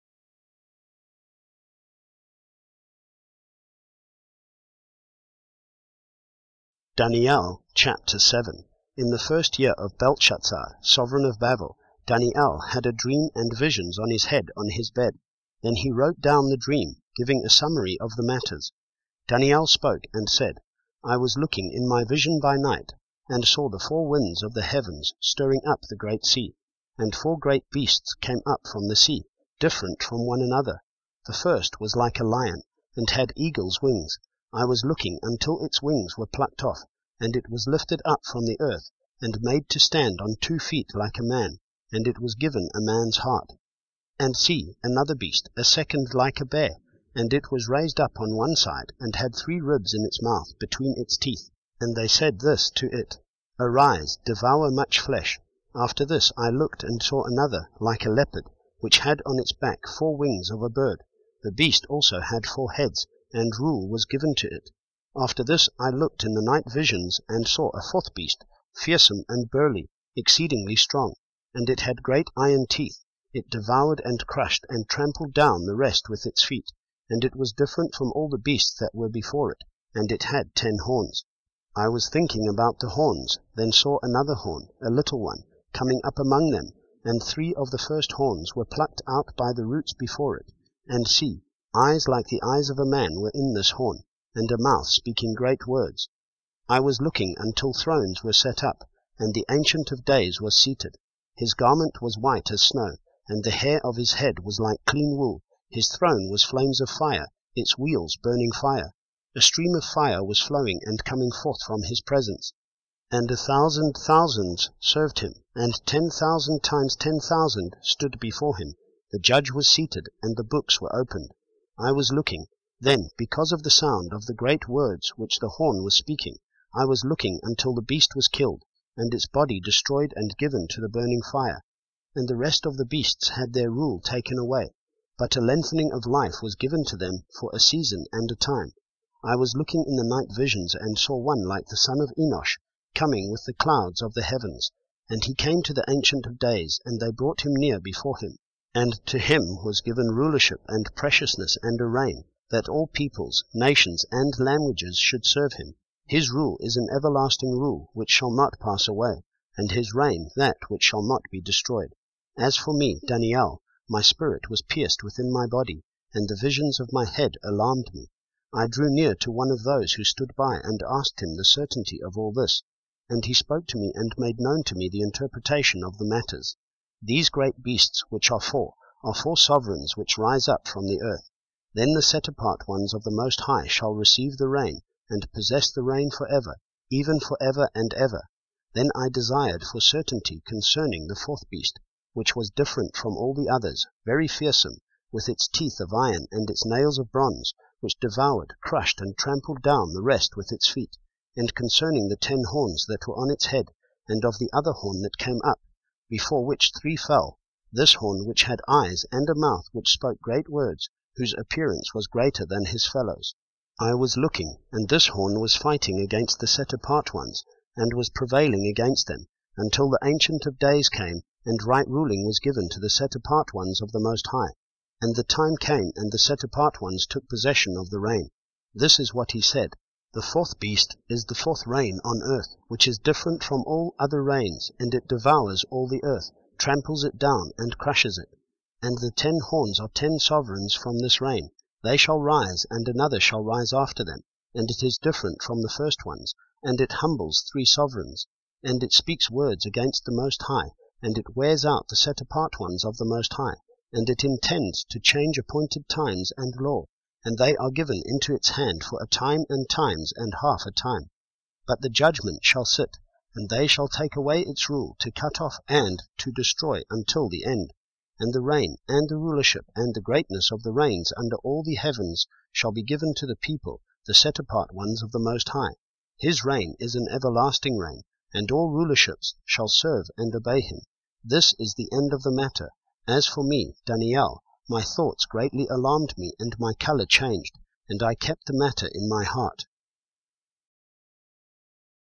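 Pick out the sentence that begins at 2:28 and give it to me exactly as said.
And to him was given rulership and preciousness and a reign, that all peoples, nations, and languages should serve him.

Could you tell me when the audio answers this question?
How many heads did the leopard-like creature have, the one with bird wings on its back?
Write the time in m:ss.
1:02.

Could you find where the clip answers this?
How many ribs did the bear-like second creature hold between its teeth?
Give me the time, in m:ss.
0:49.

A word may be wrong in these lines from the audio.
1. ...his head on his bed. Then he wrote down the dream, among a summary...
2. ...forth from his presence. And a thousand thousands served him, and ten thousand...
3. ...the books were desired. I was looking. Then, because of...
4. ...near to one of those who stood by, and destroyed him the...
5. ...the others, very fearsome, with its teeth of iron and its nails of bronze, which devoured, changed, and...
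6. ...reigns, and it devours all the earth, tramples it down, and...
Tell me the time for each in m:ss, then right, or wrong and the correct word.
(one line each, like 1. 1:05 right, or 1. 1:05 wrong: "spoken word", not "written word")
1. 0:14 wrong: "giving", not "among"
2. 1:51 right
3. 2:00 wrong: "opened", not "desired"
4. 2:48 wrong: "asked", not "destroyed"
5. 3:13 wrong: "crushed", not "changed"
6. 3:54 right.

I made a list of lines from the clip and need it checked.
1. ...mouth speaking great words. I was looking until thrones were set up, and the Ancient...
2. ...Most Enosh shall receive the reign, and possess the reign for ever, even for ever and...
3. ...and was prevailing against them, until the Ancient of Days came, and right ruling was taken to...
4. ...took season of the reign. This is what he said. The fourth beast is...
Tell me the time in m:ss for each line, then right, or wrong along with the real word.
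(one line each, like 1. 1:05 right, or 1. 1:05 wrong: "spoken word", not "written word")
1. 1:34 right
2. 3:03 wrong: "High", not "Enosh"
3. 3:37 wrong: "given", not "taken"
4. 3:47 wrong: "possession", not "season".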